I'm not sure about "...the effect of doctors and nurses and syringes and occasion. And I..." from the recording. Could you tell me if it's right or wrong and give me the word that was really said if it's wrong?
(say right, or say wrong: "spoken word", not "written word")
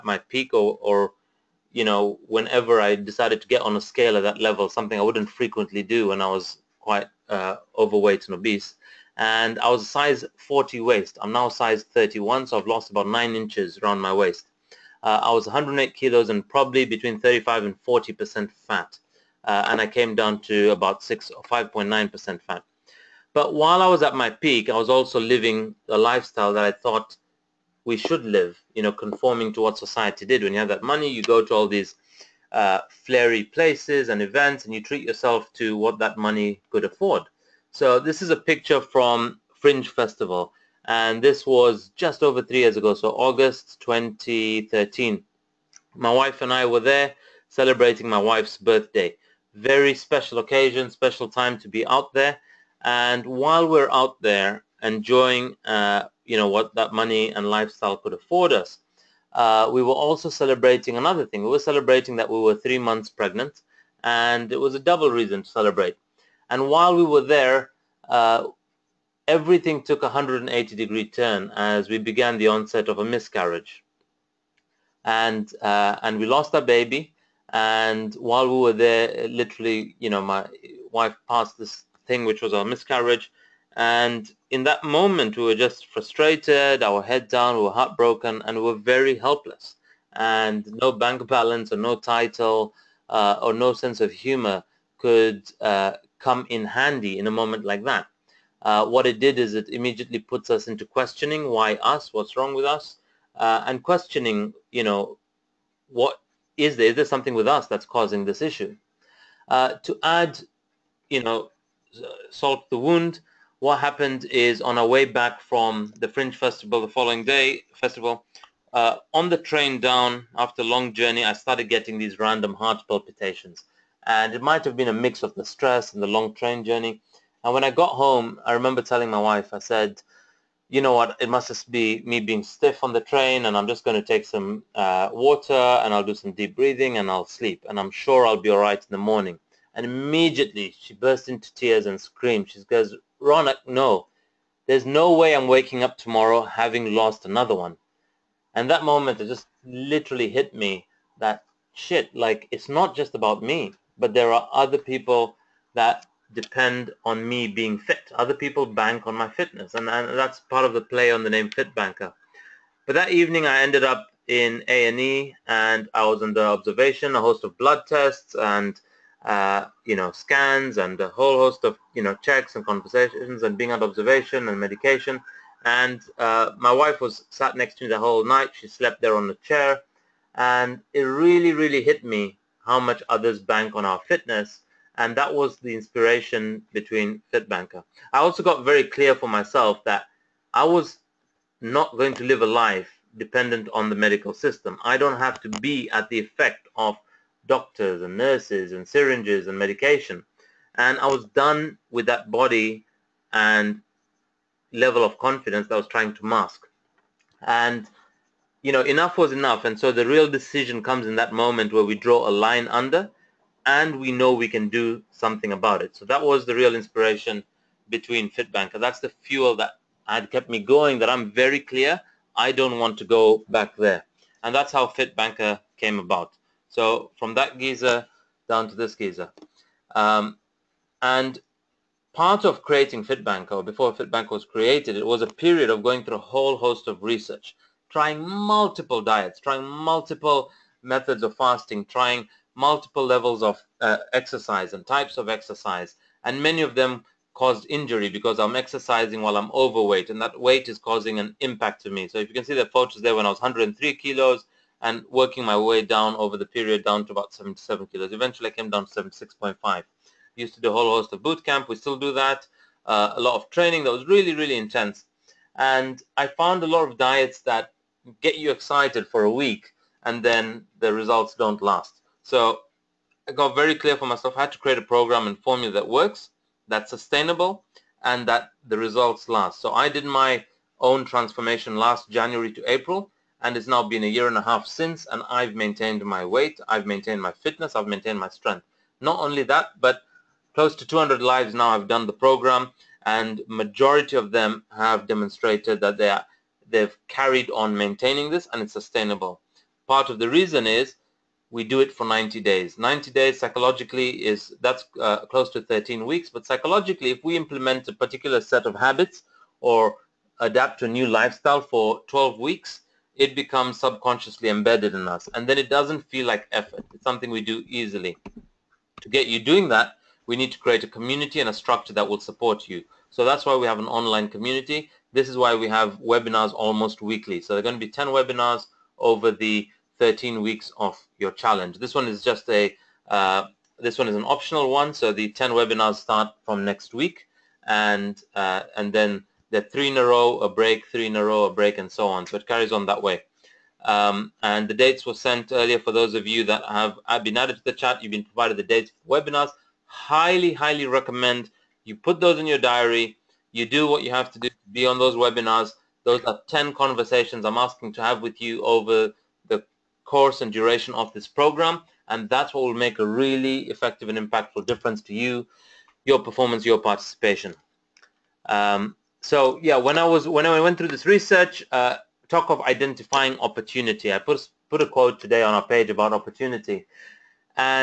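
wrong: "medication", not "occasion".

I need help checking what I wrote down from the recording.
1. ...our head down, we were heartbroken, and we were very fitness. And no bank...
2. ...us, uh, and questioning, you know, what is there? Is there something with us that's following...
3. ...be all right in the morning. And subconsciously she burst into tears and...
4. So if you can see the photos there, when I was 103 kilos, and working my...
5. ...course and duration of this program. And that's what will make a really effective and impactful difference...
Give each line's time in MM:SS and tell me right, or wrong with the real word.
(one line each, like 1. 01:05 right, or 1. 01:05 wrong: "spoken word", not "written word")
1. 01:26 wrong: "helpless", not "fitness"
2. 01:42 wrong: "causing", not "following"
3. 02:18 wrong: "immediately", not "subconsciously"
4. 04:12 right
5. 06:00 right.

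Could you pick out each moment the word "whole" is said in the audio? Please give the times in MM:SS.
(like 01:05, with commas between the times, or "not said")
02:51, 02:57, 03:56, 04:20.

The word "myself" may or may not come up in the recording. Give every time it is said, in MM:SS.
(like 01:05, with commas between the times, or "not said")
03:09, 04:34.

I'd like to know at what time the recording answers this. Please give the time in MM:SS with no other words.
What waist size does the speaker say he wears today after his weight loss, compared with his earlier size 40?
00:11.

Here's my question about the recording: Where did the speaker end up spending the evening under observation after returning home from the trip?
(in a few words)
A&E.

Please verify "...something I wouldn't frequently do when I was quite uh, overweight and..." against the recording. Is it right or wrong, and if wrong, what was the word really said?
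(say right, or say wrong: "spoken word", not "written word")
right.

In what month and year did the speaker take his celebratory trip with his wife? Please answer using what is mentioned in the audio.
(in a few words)
August 2013.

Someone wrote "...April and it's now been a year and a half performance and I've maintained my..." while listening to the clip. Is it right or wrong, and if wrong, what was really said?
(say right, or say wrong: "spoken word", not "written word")
wrong: "since", not "performance".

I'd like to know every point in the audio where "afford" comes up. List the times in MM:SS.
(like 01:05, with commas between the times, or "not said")
00:36, 00:58.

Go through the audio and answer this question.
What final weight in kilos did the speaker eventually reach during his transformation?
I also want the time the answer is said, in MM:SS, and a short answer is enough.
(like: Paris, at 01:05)
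76.5, at 04:19.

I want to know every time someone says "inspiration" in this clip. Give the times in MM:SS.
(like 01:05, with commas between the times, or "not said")
03:05, 03:36.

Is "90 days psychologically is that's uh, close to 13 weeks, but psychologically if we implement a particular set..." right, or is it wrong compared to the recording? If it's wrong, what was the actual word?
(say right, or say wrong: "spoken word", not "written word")
right.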